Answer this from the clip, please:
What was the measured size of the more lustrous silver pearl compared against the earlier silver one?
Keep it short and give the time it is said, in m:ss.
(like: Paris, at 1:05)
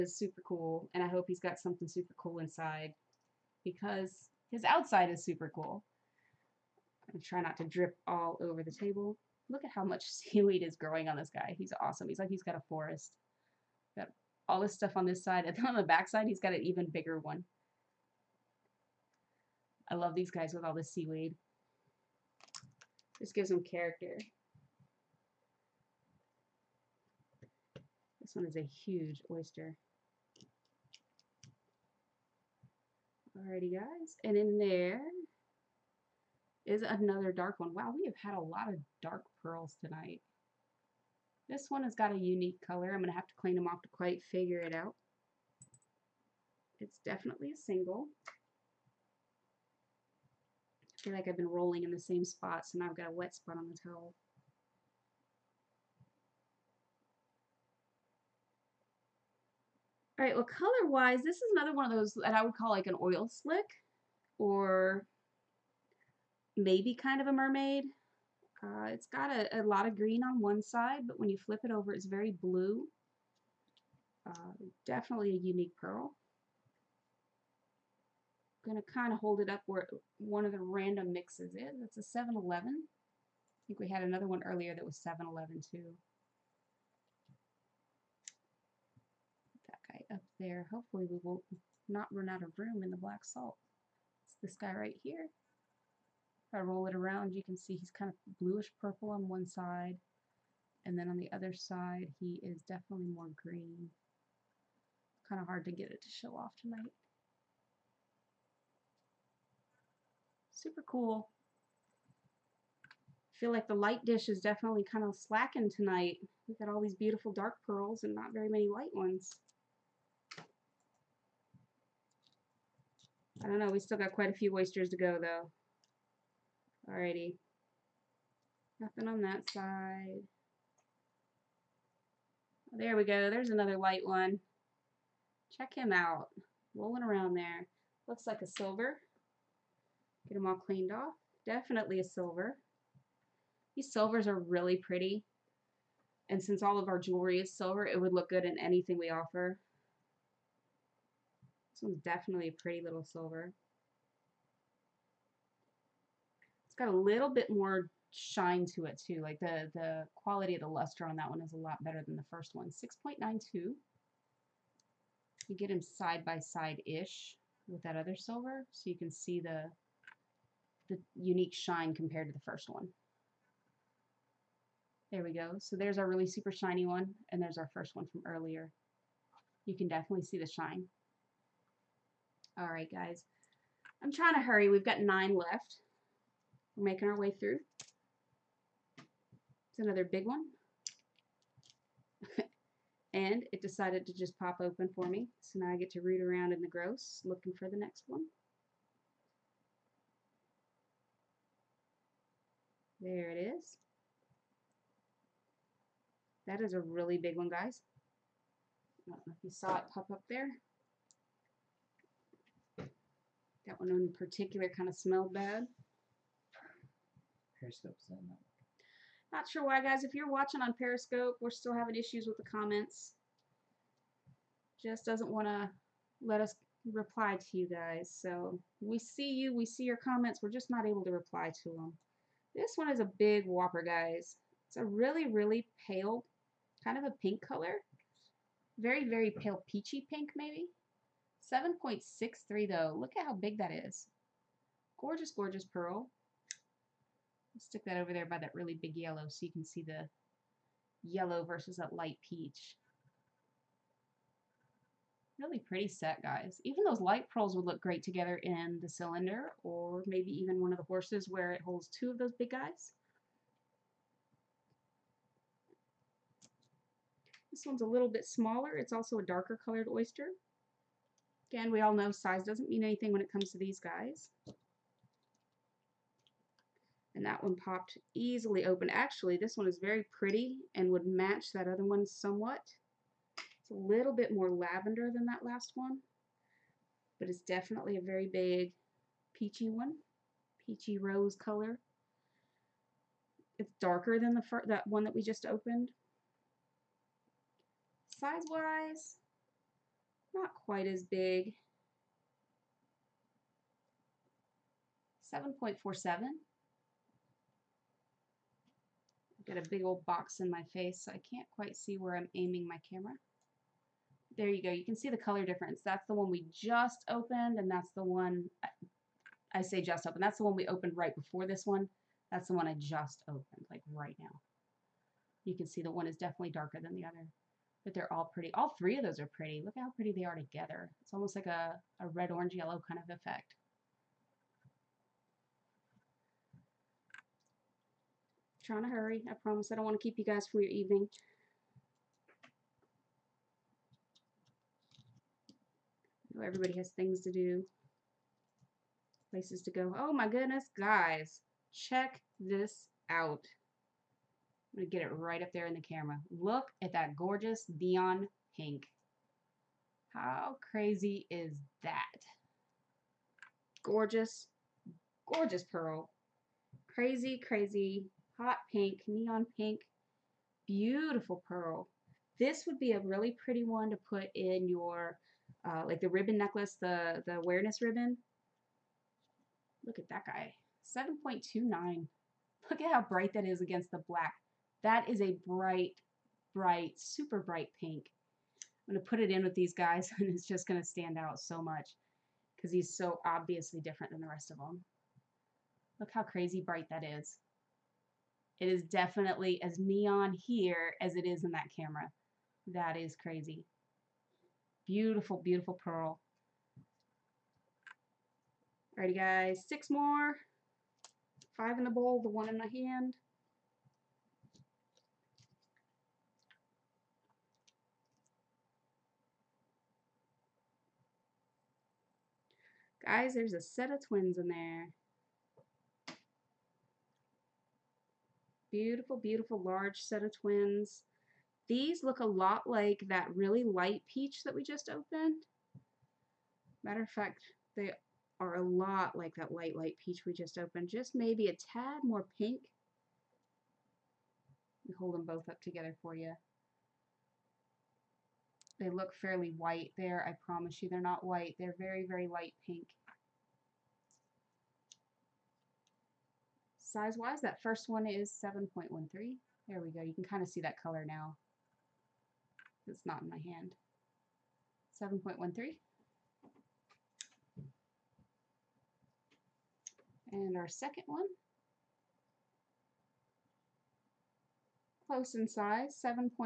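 6.92, at 2:42.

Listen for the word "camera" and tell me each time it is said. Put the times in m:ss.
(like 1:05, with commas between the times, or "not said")
5:12, 5:55, 6:41.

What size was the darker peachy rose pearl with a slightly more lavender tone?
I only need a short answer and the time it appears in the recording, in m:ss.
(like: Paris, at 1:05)
7.47, at 5:05.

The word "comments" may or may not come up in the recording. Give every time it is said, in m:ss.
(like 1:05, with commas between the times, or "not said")
3:42, 3:49.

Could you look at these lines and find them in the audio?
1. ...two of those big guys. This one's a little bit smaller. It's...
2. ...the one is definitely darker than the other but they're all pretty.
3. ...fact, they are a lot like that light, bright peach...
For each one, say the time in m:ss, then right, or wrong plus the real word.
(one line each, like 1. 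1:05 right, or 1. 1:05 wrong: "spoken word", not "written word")
1. 4:21 right
2. 5:25 right
3. 7:17 wrong: "light", not "bright".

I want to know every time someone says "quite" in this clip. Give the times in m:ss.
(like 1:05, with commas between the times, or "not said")
0:43, 2:04, 5:00, 5:11.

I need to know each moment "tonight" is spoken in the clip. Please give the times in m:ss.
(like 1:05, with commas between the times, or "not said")
0:39, 1:46, 1:55.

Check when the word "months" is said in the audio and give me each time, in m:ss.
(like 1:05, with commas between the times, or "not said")
not said.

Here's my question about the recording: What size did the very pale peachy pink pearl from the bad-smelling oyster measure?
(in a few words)
7.63.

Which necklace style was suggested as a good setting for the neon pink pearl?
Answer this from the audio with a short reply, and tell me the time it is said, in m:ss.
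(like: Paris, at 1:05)
awareness ribbon, at 6:17.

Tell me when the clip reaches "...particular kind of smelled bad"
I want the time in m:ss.
3:34.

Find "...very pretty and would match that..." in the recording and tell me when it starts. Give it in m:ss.
4:39.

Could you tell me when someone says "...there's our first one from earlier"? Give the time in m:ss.
2:57.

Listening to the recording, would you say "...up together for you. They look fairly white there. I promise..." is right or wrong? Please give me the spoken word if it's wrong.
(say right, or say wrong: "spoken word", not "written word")
right.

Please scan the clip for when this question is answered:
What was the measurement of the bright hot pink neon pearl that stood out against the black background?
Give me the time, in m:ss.
6:20.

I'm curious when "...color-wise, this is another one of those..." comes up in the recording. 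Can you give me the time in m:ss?
1:00.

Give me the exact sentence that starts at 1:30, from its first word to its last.
there, hopefully we will not run out of room in the black salt.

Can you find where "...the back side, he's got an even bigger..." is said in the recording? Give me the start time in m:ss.
0:15.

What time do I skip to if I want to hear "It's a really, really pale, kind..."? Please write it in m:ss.
3:54.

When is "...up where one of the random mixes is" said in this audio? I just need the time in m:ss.
1:19.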